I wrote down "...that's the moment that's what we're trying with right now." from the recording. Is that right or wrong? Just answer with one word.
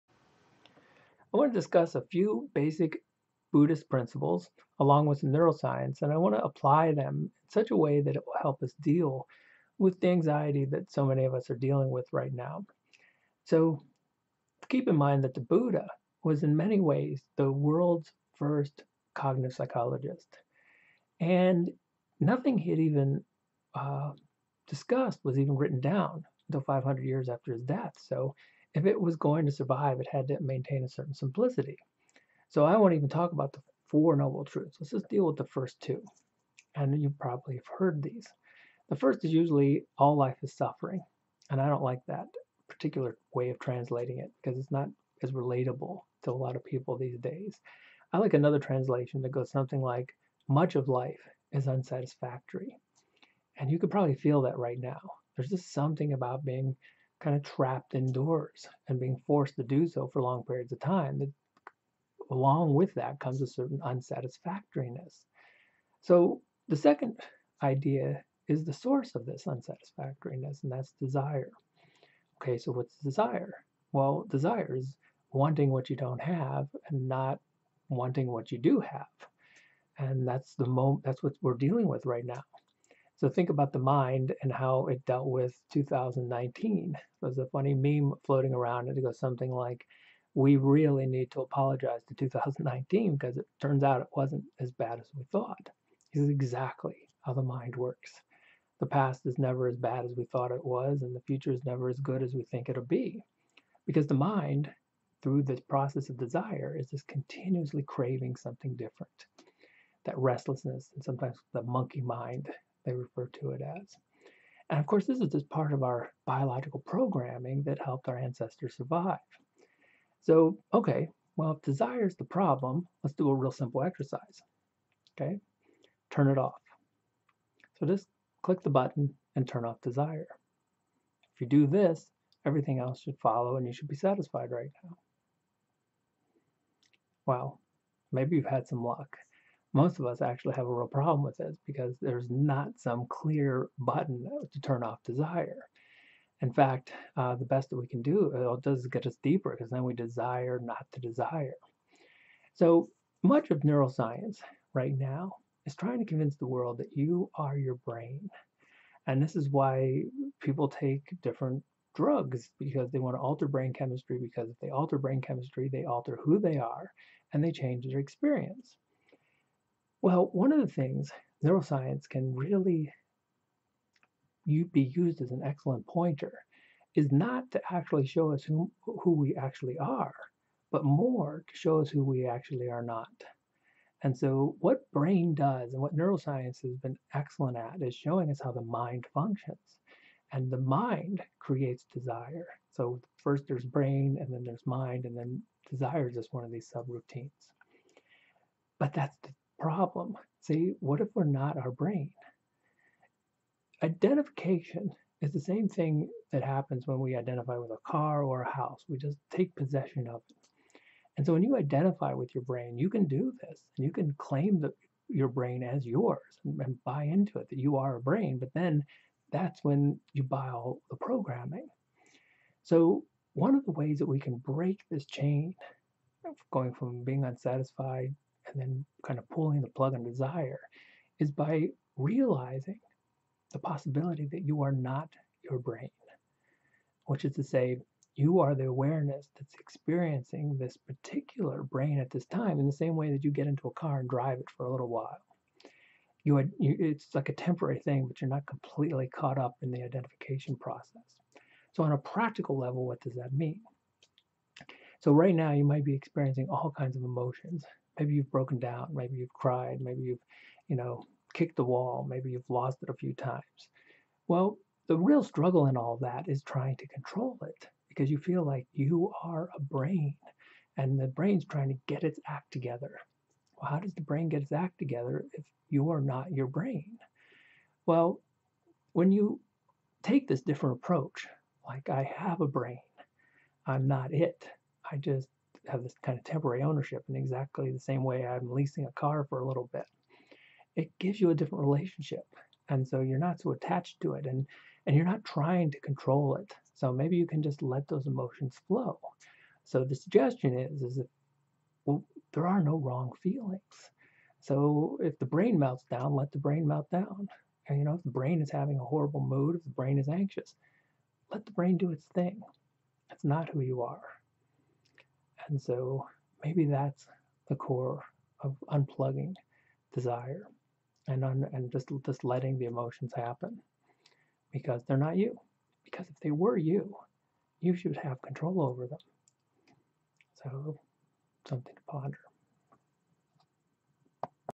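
wrong.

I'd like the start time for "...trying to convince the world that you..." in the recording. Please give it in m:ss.
2:35.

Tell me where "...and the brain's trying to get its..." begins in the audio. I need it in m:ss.
4:30.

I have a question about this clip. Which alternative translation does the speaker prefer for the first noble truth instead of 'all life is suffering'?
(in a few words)
much of life is unsatisfactory.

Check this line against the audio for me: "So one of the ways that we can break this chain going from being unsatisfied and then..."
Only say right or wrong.
right.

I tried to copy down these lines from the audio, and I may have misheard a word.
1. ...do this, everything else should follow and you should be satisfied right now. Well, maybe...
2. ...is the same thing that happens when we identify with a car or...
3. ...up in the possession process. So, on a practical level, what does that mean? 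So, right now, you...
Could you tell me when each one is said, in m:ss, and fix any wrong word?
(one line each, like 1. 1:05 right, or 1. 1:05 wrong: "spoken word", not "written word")
1. 2:11 right
2. 3:25 right
3. 4:09 wrong: "identification", not "possession".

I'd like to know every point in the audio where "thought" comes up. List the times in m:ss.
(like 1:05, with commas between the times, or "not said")
1:35, 1:40.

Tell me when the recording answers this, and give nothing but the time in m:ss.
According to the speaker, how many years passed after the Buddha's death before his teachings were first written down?
0:26.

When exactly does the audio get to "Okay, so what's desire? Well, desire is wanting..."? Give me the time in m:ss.
1:12.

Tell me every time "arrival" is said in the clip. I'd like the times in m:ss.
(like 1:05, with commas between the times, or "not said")
not said.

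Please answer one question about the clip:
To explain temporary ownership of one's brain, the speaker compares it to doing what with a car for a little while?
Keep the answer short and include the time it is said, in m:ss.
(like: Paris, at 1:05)
leasing, at 4:48.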